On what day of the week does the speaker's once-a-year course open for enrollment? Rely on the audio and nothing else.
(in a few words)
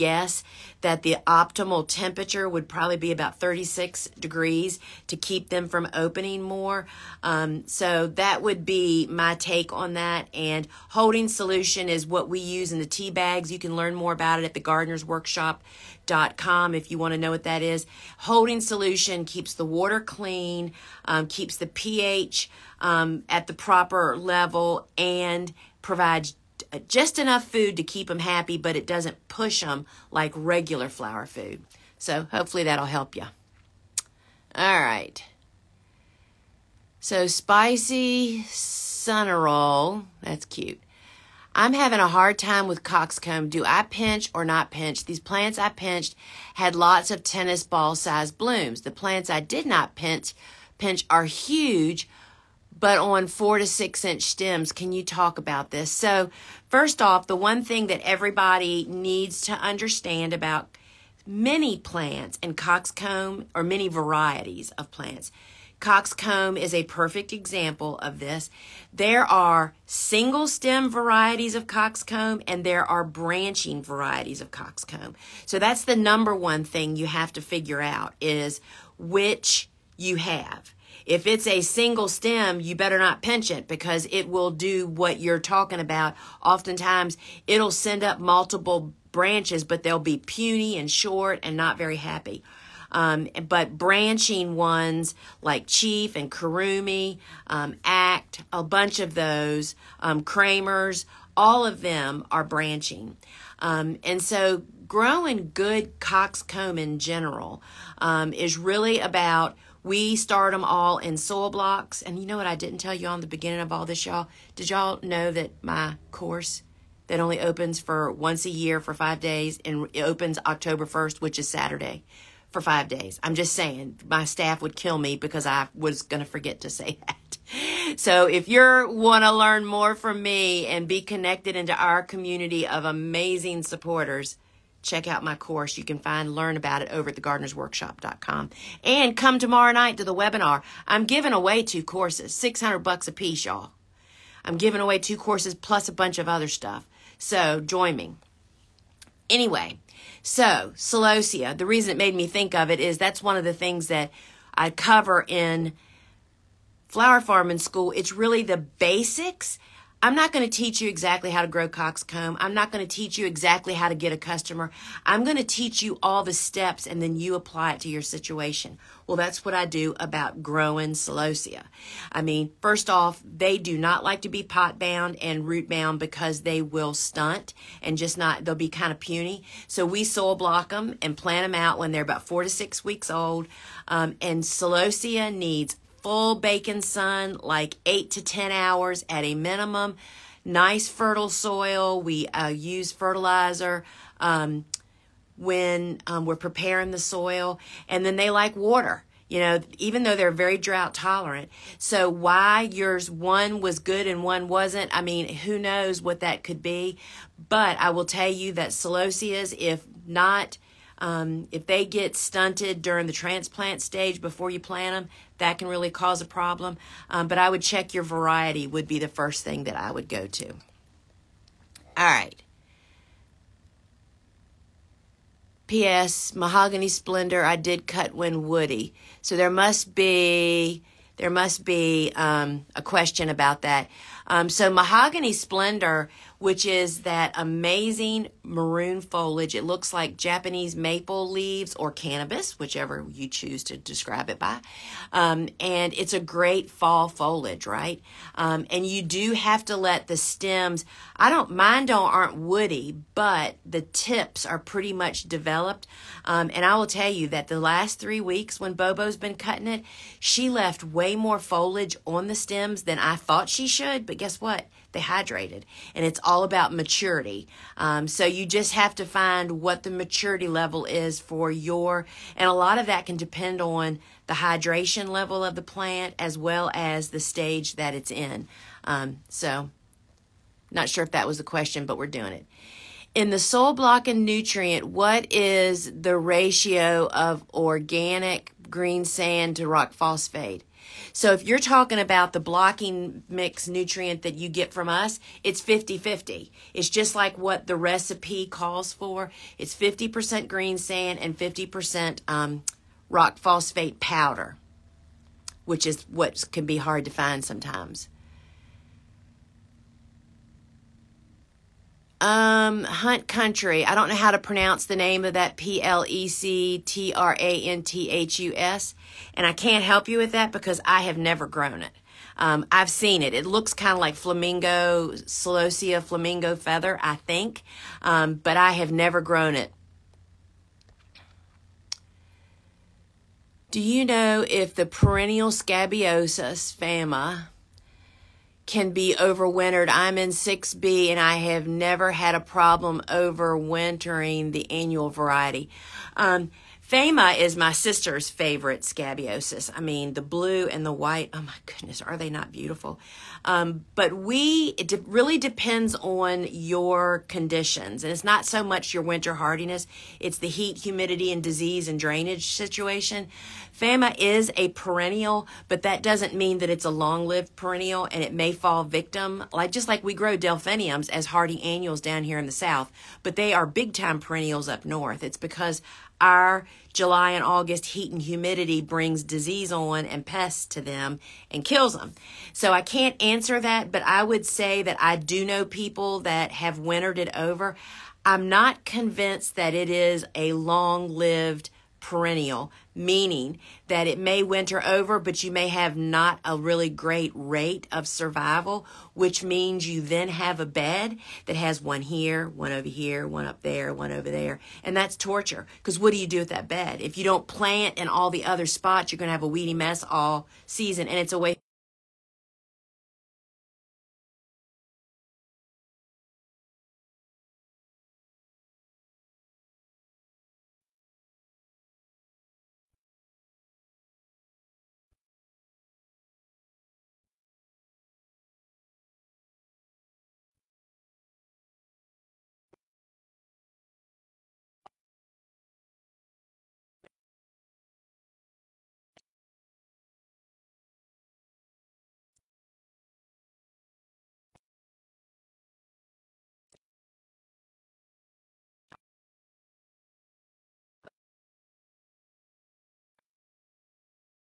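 Saturday.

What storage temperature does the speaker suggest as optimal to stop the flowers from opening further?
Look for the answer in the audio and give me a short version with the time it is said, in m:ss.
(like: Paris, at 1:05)
36 degrees, at 0:03.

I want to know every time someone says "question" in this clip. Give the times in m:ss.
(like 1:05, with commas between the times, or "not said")
3:52, 4:41.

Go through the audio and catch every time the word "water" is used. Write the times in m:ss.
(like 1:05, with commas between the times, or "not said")
0:19, 3:18.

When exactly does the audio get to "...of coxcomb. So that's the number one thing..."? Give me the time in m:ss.
1:14.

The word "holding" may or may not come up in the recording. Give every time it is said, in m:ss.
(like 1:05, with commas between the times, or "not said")
0:10, 0:18.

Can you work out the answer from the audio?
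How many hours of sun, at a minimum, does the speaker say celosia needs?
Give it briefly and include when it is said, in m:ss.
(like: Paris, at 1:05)
8 to 10 hours, at 3:07.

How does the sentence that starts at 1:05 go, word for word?
Coxcomb is a perfect example of this.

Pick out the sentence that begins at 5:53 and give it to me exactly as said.
Um, but we, it de really depends on your conditions.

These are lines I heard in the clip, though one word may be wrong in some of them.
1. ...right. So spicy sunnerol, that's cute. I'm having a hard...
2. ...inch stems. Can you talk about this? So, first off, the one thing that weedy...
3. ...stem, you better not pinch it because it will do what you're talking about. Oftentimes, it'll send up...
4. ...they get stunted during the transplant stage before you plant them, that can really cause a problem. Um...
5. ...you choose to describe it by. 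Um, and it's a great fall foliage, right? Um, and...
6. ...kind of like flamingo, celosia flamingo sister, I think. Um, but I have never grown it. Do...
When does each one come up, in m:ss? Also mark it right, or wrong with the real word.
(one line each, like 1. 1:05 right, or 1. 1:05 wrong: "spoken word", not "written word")
1. 0:34 right
2. 0:54 wrong: "everybody", not "weedy"
3. 1:22 right
4. 3:31 right
5. 4:03 right
6. 5:23 wrong: "feather", not "sister".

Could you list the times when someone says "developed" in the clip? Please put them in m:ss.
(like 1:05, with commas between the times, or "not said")
4:15.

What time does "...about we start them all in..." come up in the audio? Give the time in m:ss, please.
1:48.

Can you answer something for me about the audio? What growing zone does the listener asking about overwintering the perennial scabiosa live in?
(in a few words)
6B.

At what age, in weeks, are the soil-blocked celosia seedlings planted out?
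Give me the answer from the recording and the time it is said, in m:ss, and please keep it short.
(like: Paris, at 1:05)
4 to 6 weeks, at 3:02.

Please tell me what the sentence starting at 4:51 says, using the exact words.
So if you're talking about the blocking mix nutrient that you get from us, it's 50-50.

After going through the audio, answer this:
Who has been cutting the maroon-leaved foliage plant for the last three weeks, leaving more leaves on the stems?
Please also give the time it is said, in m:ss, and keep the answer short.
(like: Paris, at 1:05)
Bobo, at 4:18.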